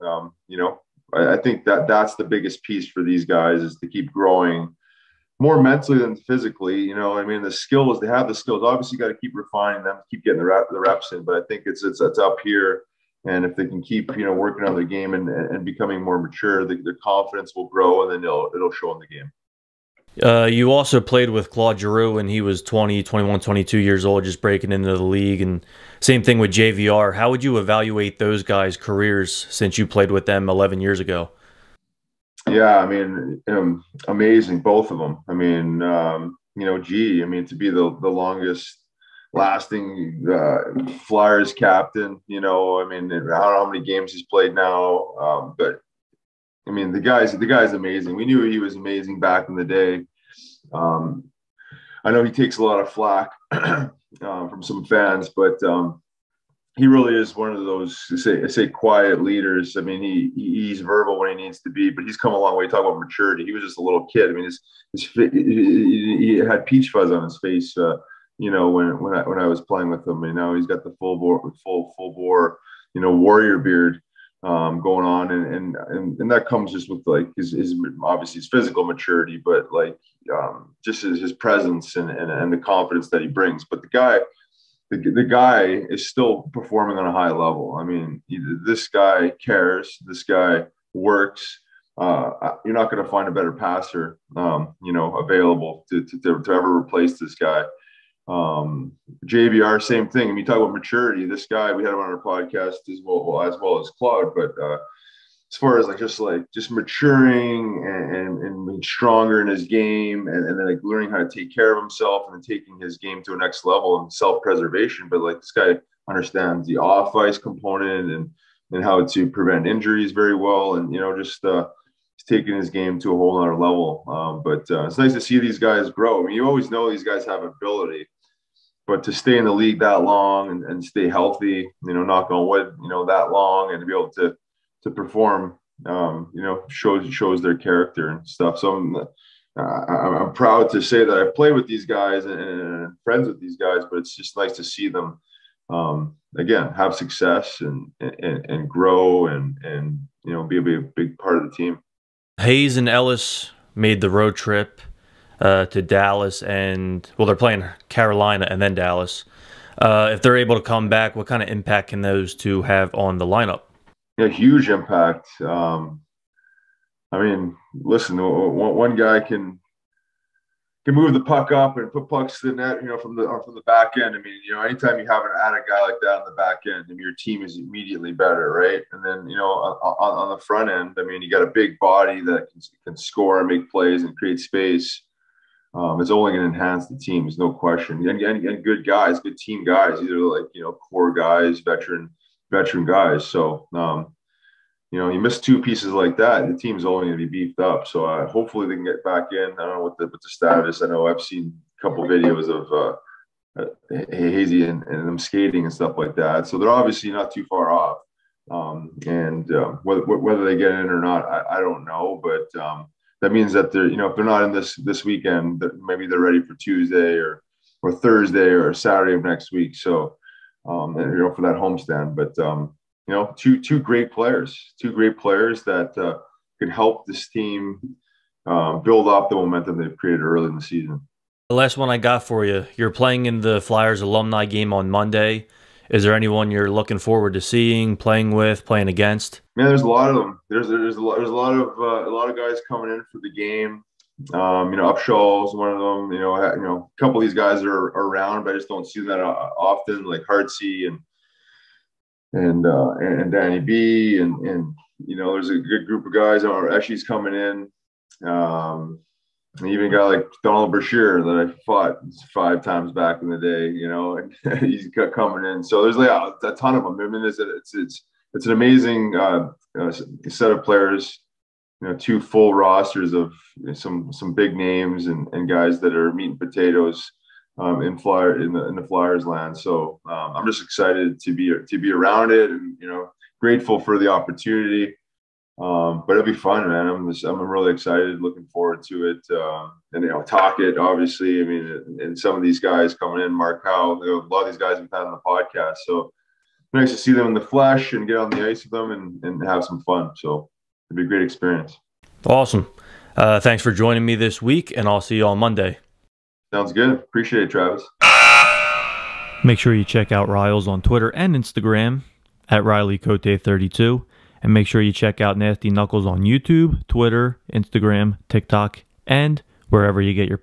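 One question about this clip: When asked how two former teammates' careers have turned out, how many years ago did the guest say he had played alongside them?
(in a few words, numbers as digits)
11 years.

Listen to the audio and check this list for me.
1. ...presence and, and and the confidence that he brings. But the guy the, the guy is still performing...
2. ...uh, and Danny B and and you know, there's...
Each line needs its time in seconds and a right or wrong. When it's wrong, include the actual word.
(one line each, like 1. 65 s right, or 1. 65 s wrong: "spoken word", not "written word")
1. 81 s right
2. 252 s right.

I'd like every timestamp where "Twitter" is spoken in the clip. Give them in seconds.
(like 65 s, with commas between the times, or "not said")
310 s, 316 s.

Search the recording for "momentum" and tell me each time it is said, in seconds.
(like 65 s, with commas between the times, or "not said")
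229 s.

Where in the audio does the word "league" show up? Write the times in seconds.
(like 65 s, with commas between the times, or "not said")
25 s, 129 s.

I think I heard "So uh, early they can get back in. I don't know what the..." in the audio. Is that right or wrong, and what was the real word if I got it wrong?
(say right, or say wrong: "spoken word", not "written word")
wrong: "hopefully", not "early".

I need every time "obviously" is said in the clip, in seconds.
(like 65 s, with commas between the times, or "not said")
8 s, 78 s, 206 s, 290 s.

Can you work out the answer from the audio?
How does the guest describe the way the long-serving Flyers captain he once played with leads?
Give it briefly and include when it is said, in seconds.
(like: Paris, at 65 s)
Quiet leaders, at 58 s.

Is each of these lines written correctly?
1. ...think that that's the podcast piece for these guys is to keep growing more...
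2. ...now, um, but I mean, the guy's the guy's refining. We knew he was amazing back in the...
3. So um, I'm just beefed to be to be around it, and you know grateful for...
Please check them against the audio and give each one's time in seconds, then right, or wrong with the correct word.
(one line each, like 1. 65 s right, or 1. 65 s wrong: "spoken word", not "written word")
1. 1 s wrong: "biggest", not "podcast"
2. 44 s wrong: "amazing", not "refining"
3. 279 s wrong: "excited", not "beefed".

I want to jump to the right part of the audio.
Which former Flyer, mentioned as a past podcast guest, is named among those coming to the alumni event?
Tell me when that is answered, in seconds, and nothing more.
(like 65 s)
293 s.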